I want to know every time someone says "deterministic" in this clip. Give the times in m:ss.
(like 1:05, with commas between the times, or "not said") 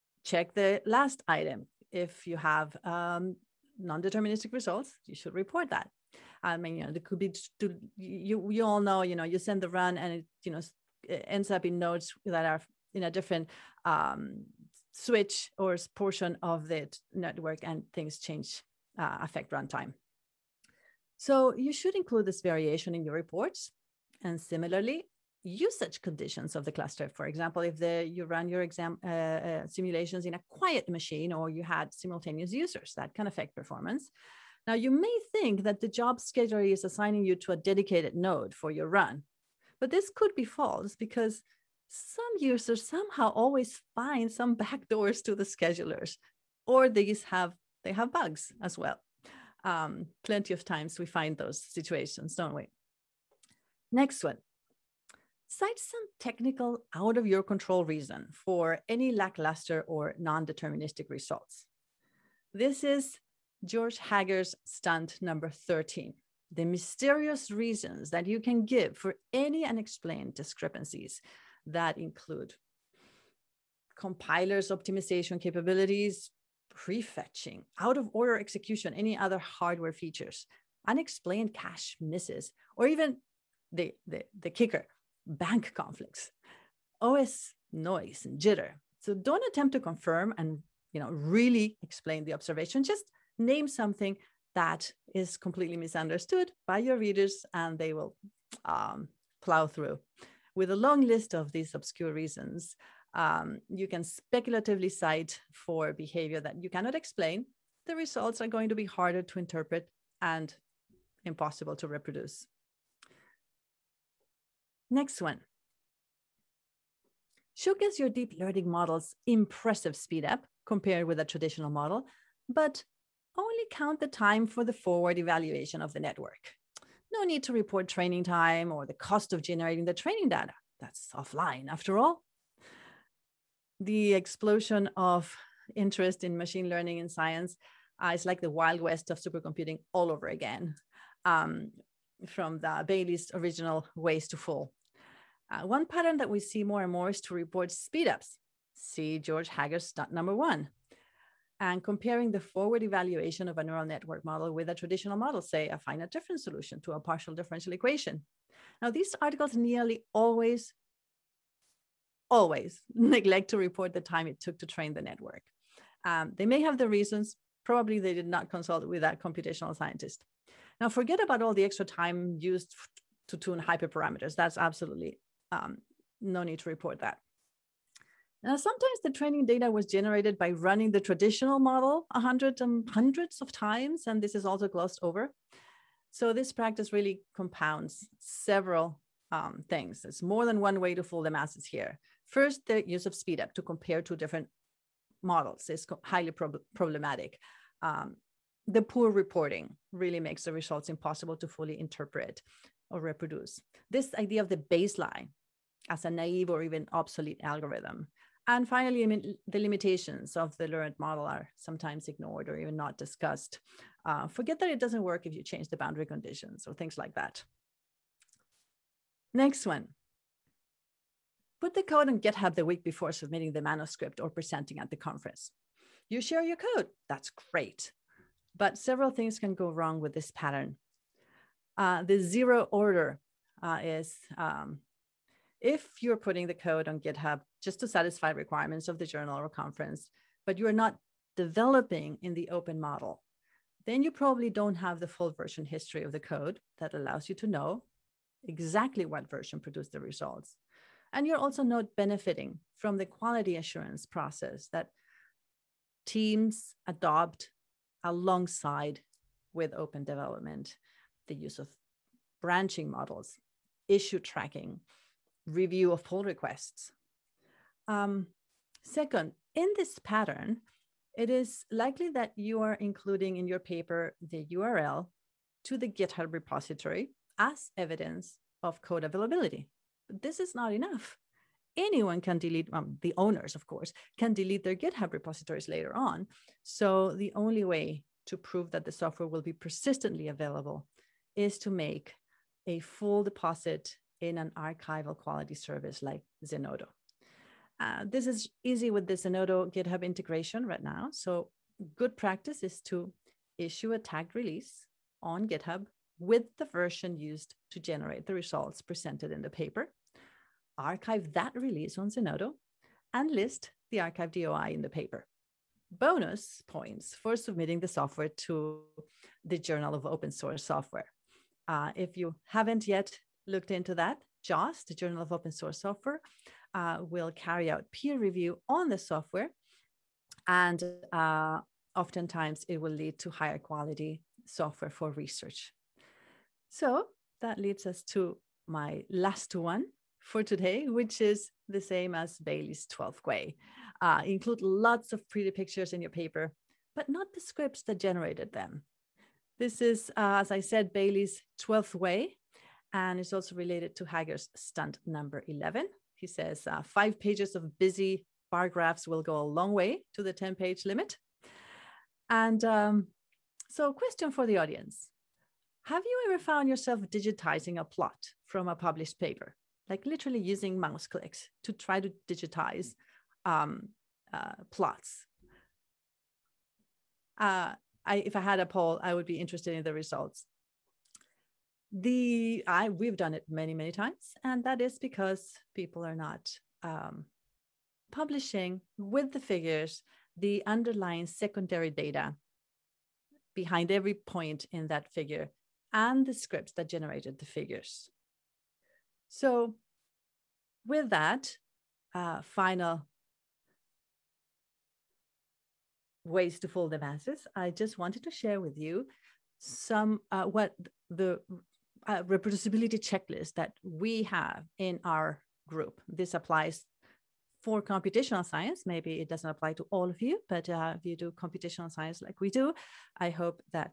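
0:03, 1:00.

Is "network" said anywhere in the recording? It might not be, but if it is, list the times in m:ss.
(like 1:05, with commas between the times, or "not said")
0:17, 2:05, 2:33, 2:45.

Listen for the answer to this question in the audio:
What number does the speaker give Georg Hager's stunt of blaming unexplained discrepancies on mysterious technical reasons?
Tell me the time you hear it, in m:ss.
1:05.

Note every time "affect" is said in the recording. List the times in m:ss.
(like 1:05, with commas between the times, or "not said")
0:19, 0:33.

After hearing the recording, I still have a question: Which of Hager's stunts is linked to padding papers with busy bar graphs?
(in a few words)
number 11.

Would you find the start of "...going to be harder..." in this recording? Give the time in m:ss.
1:48.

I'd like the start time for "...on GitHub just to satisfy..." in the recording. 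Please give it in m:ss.
3:56.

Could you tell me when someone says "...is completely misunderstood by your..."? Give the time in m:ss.
1:35.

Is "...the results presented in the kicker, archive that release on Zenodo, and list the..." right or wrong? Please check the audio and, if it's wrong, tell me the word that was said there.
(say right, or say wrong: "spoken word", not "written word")
wrong: "paper", not "kicker".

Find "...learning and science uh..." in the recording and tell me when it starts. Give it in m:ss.
2:16.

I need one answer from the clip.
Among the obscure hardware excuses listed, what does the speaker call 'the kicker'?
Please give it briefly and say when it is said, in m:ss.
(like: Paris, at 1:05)
bank conflicts, at 1:25.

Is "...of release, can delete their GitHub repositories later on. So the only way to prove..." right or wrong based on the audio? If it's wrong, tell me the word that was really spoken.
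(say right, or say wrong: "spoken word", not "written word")
wrong: "course", not "release".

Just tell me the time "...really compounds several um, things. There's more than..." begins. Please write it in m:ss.
3:06.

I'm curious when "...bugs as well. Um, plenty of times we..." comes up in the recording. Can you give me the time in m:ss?
0:48.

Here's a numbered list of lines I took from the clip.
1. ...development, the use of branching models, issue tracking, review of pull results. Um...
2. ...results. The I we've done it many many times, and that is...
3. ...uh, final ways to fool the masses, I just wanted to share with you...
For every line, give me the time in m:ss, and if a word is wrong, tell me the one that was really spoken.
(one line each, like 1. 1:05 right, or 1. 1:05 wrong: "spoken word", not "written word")
1. 4:20 wrong: "requests", not "results"
2. 6:19 right
3. 6:42 right.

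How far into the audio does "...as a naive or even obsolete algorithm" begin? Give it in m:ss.
3:25.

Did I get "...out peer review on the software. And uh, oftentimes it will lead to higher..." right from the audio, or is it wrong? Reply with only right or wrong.
right.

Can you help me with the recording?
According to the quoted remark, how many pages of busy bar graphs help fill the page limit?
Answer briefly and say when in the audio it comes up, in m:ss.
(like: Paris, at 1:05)
5, at 5:56.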